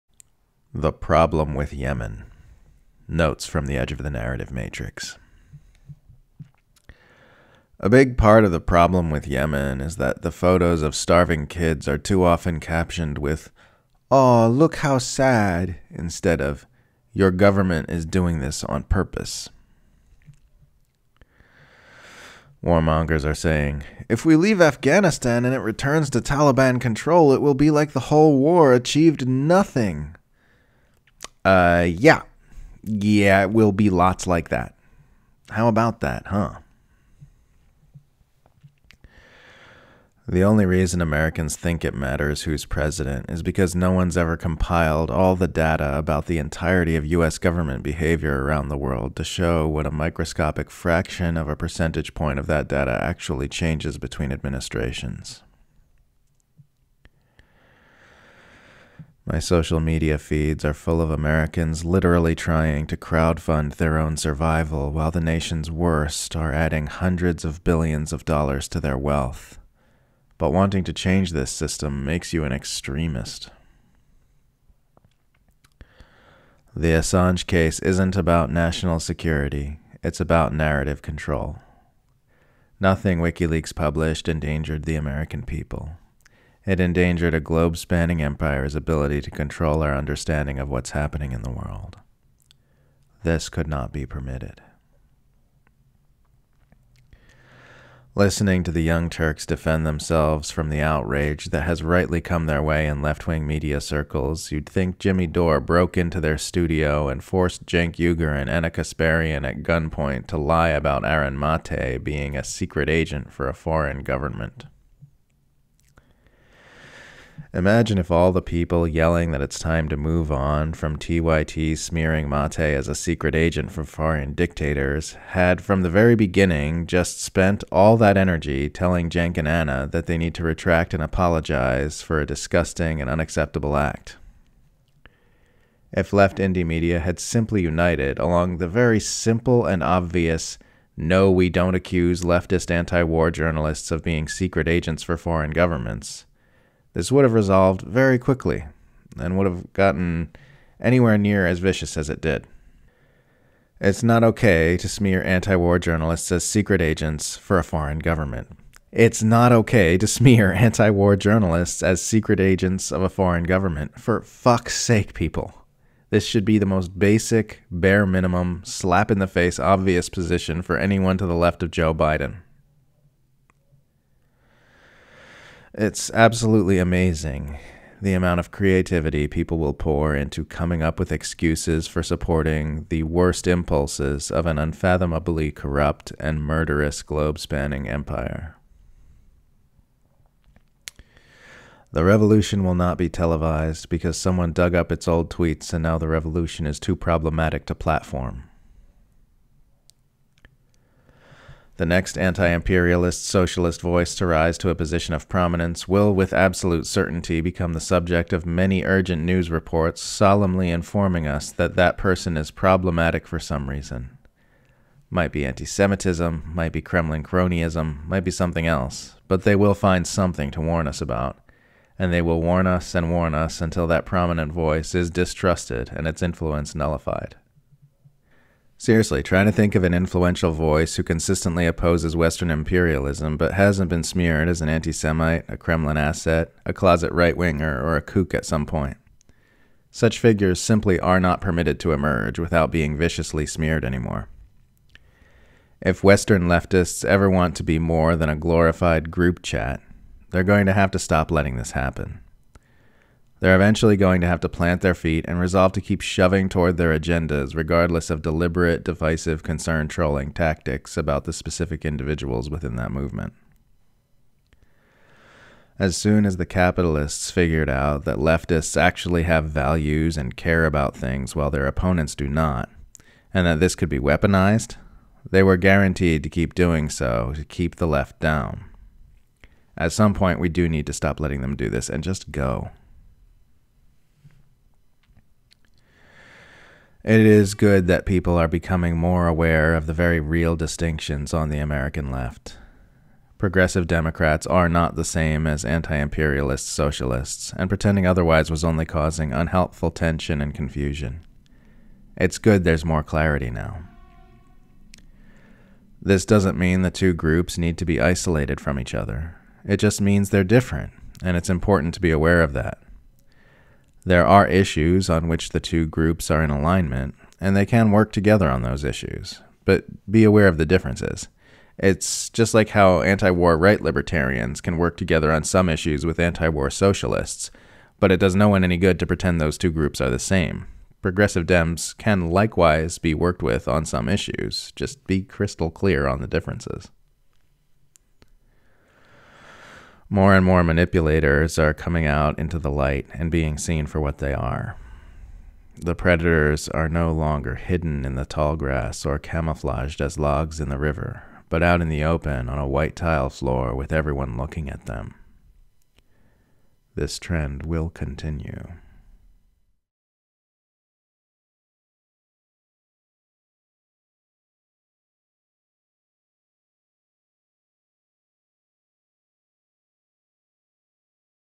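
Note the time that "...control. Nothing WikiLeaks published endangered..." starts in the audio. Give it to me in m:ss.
1:21.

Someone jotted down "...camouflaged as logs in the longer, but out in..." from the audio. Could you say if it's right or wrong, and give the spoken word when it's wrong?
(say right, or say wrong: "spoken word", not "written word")
wrong: "river", not "longer".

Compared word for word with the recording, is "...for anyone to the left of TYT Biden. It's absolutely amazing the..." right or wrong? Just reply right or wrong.
wrong.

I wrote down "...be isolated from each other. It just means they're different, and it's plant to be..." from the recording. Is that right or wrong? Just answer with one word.
wrong.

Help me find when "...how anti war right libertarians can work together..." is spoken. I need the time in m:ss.
5:22.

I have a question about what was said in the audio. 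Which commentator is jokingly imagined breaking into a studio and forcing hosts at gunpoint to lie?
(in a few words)
Jimmy Dore.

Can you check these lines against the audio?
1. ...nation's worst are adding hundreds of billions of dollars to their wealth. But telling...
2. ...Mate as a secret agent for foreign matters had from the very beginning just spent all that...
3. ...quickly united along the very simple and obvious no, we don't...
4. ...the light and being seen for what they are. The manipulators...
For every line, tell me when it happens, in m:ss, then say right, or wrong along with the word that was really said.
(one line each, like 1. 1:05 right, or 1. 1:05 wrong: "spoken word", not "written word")
1. 1:05 wrong: "wanting", not "telling"
2. 2:02 wrong: "dictators", not "matters"
3. 2:17 wrong: "simply", not "quickly"
4. 5:42 wrong: "predators", not "manipulators".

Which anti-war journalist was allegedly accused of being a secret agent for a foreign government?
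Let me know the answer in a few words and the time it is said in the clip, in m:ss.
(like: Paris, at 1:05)
Aaron Mate, at 1:51.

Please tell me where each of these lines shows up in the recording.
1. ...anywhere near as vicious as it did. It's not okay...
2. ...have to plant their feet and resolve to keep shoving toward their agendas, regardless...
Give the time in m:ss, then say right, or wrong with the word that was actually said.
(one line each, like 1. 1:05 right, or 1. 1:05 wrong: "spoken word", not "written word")
1. 2:30 right
2. 4:14 right.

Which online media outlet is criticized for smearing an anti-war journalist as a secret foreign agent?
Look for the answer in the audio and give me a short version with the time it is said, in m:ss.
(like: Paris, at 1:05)
The Young Turks, at 1:38.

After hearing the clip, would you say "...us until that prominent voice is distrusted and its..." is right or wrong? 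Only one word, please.
right.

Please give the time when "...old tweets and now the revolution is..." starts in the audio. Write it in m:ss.
3:15.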